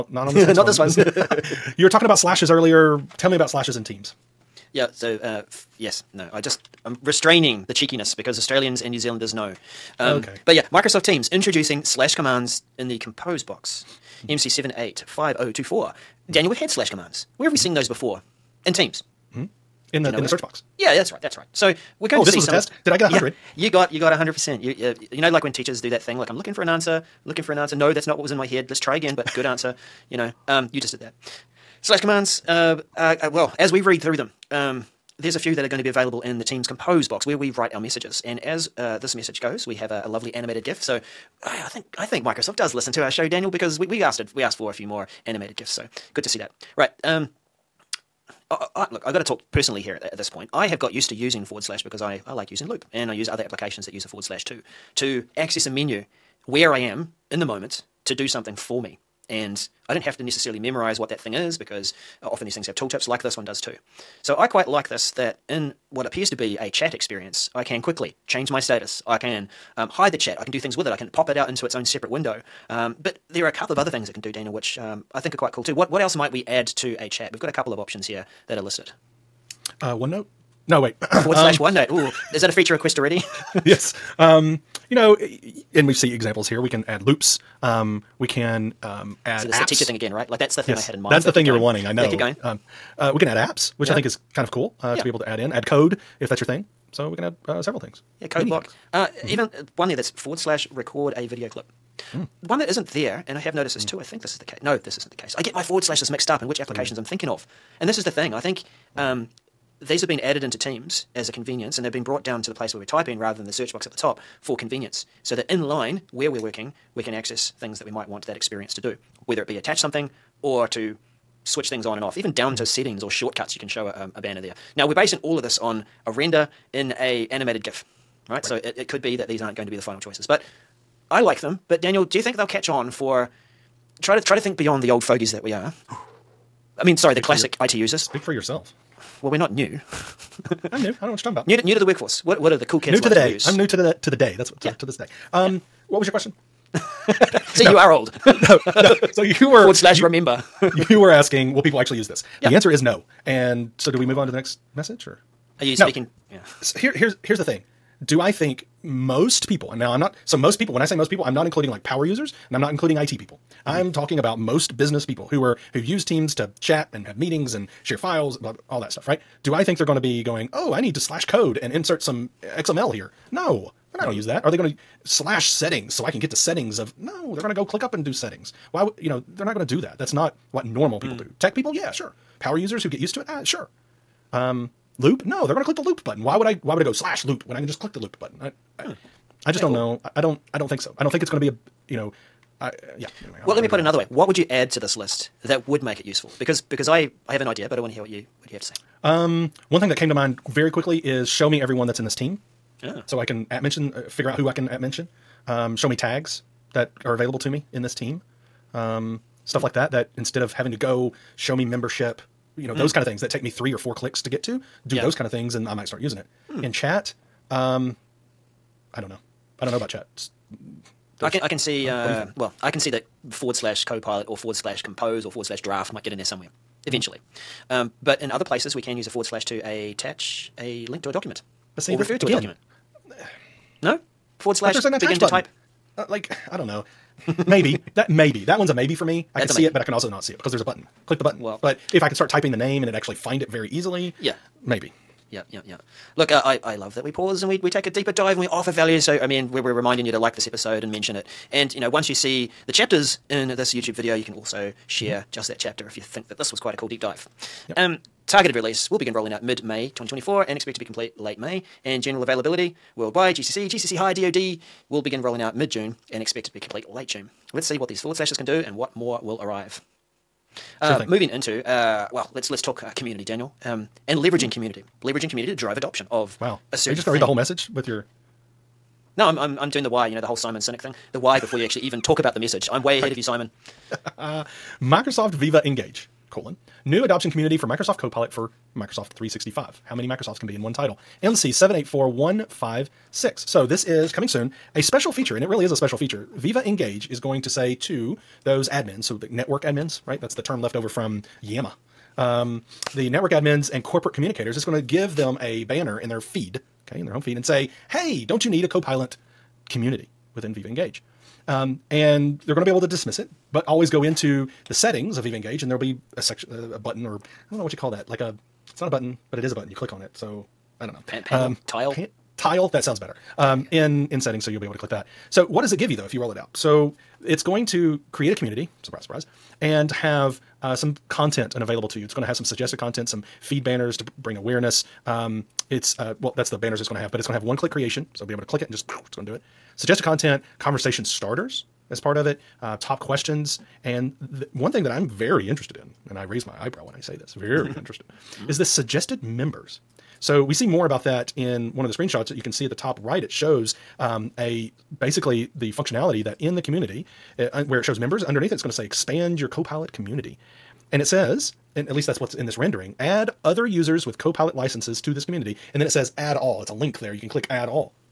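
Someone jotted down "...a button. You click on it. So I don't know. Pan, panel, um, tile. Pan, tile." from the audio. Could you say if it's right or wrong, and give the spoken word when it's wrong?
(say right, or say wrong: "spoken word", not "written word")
right.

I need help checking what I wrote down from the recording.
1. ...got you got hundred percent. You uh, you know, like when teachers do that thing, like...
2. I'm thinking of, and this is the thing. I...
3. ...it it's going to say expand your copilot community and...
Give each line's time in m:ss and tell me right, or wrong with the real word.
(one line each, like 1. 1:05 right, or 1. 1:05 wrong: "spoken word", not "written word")
1. 0:23 right
2. 1:47 right
3. 5:58 right.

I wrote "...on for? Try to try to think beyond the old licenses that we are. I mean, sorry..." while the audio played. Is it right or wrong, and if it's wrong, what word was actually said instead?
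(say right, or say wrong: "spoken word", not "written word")
wrong: "fogies", not "licenses".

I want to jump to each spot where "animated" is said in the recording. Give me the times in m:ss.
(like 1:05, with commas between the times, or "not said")
0:40, 0:45, 2:07.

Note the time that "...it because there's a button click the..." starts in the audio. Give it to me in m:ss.
4:00.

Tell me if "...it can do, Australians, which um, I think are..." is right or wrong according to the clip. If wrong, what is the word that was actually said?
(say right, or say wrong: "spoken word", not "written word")
wrong: "Daniel", not "Australians".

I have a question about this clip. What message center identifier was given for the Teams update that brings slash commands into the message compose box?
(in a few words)
MC785024.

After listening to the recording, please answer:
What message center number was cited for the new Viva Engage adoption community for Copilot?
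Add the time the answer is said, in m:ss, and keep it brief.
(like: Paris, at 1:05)
MC784156, at 4:51.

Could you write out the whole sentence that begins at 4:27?
Let's see what these forward slashes can do and what more will arrive.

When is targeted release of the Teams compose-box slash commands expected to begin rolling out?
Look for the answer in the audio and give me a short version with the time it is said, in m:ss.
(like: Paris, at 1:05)
mid-May 2024, at 4:19.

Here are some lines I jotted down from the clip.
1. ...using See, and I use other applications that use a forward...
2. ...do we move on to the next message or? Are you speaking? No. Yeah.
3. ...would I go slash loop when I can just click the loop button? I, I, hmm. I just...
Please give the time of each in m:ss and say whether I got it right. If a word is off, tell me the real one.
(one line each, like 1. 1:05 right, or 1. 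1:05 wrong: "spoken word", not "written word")
1. 0:52 wrong: "Loop", not "See"
2. 2:33 right
3. 3:06 right.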